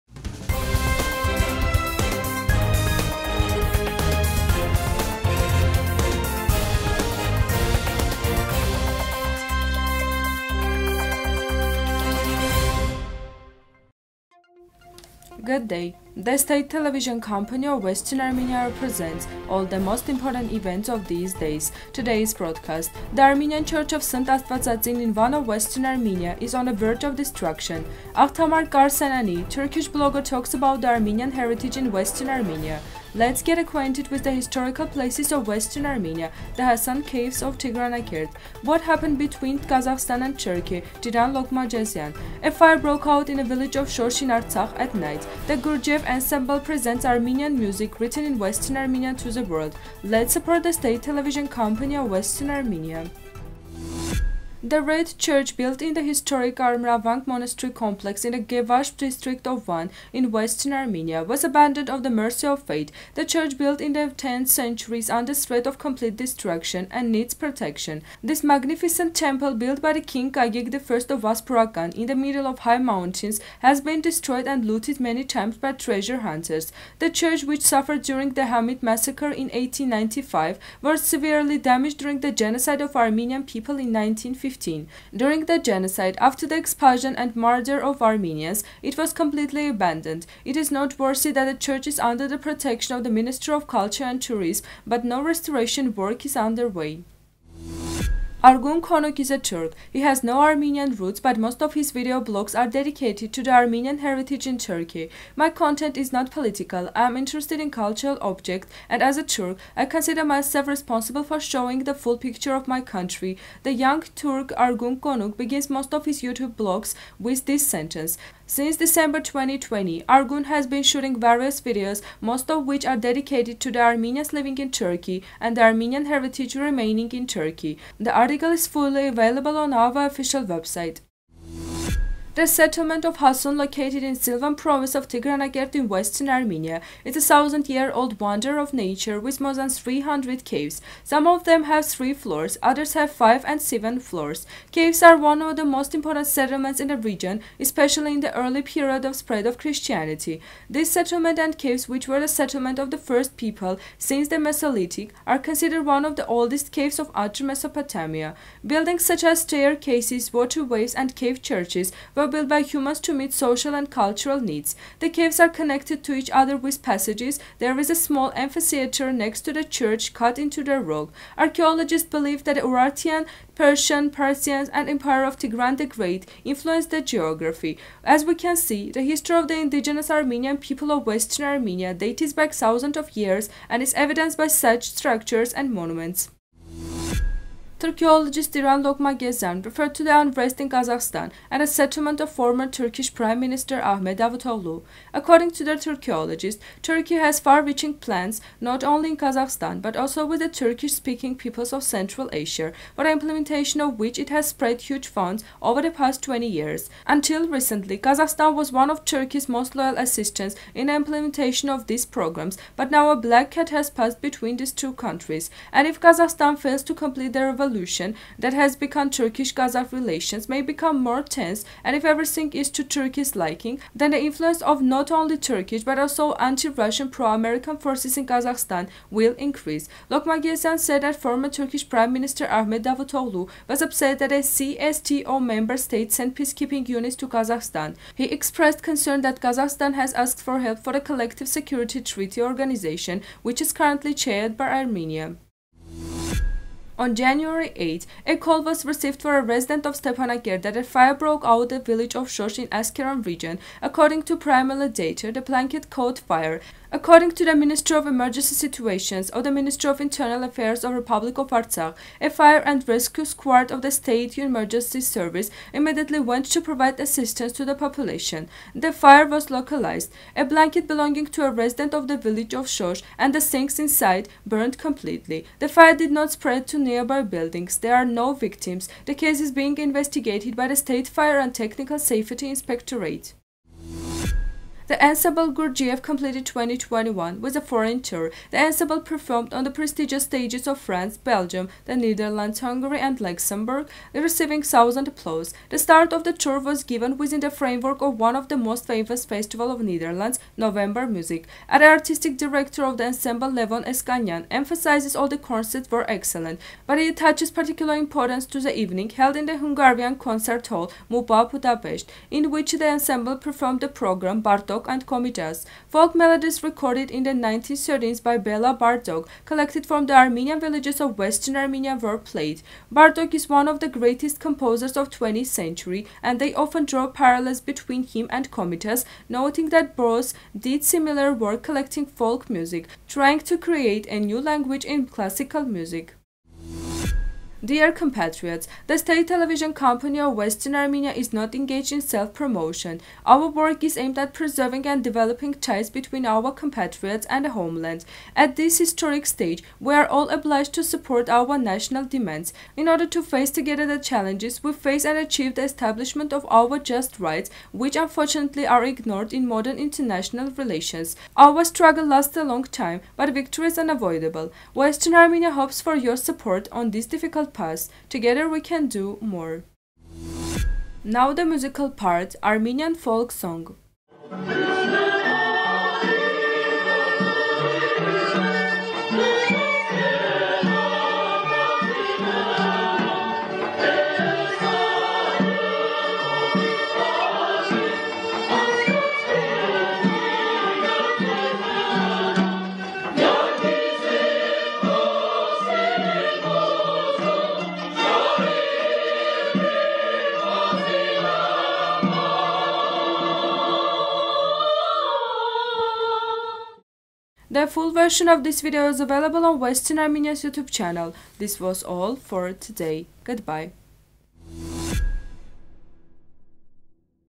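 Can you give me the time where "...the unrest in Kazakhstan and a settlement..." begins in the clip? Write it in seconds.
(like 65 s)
190 s.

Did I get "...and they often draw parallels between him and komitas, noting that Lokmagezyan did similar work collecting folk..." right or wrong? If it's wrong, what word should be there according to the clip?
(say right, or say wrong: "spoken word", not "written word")
wrong: "Boros", not "Lokmagezyan".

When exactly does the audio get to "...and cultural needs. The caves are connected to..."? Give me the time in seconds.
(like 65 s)
163 s.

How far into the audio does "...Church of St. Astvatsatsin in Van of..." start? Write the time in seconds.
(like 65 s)
23 s.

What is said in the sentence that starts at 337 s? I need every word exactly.
Dear compatriots, the state television company of Western Armenia is not engaged in self-promotion.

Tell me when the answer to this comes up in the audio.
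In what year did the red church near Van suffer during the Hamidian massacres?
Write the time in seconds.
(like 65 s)
79 s.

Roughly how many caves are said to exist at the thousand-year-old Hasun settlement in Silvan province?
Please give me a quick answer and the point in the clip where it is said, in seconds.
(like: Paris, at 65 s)
more than 300, at 139 s.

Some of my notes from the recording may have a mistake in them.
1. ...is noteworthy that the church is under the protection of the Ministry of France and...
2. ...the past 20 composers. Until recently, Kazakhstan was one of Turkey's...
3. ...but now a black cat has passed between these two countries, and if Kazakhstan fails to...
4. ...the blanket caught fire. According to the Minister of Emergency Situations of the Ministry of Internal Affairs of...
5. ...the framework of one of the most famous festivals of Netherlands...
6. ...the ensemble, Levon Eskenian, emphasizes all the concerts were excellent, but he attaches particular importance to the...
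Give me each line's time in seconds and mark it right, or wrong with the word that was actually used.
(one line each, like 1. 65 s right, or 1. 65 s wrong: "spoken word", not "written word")
1. 90 s wrong: "Culture", not "France"
2. 205 s wrong: "years", not "composers"
3. 212 s right
4. 255 s right
5. 297 s right
6. 302 s right.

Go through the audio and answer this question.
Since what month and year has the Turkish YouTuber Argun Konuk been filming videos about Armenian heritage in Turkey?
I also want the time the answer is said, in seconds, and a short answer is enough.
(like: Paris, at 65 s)
December 2020, at 118 s.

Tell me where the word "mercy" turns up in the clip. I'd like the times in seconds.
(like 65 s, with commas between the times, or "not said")
62 s.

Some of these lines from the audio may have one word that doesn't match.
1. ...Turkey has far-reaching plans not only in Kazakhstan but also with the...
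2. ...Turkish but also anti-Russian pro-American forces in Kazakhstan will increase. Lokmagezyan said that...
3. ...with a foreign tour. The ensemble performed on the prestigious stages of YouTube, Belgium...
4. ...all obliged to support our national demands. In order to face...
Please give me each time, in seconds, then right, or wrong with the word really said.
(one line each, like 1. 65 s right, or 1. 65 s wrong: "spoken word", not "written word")
1. 196 s right
2. 225 s right
3. 287 s wrong: "France", not "YouTube"
4. 350 s right.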